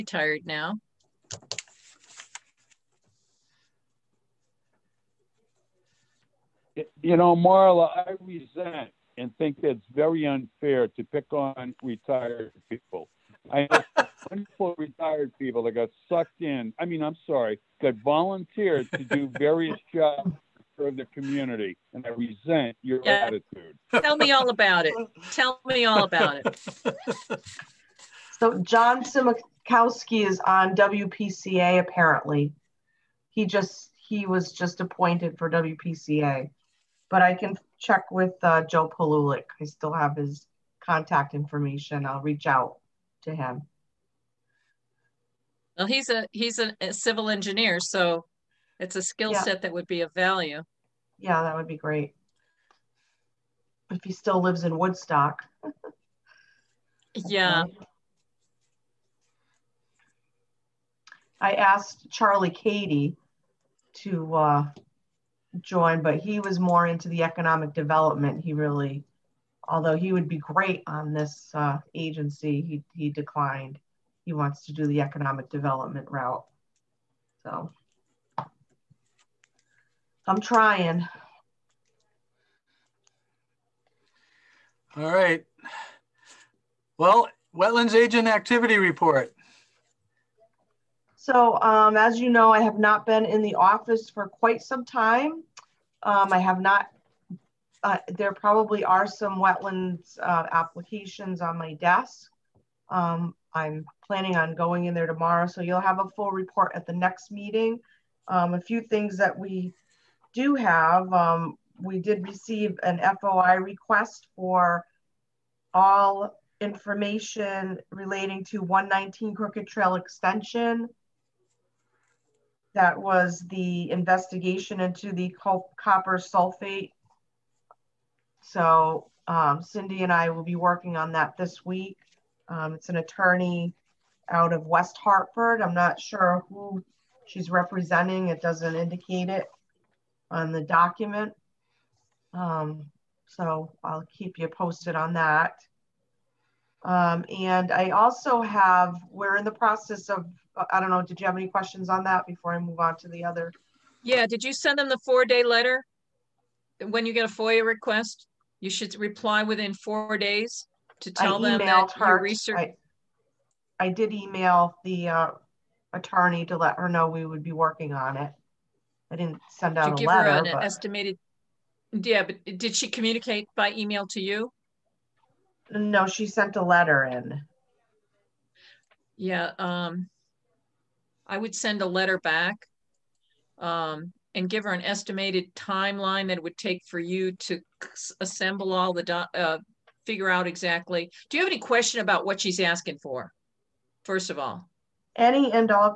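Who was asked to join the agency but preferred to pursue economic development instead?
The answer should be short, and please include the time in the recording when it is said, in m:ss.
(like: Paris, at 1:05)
Charlie Katie, at 1:02.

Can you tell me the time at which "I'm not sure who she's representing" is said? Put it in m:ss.
2:15.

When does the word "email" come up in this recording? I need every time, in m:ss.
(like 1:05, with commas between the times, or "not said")
2:44, 2:53.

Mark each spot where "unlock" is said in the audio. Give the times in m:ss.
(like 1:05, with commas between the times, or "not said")
not said.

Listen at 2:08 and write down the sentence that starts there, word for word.
So um, Cindy and I will be working on that this week.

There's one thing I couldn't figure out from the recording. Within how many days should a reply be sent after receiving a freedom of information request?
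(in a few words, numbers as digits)
4.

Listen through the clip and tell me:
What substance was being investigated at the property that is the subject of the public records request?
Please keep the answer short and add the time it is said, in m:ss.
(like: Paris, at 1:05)
copper sulfate, at 2:05.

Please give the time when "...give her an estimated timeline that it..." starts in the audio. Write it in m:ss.
3:04.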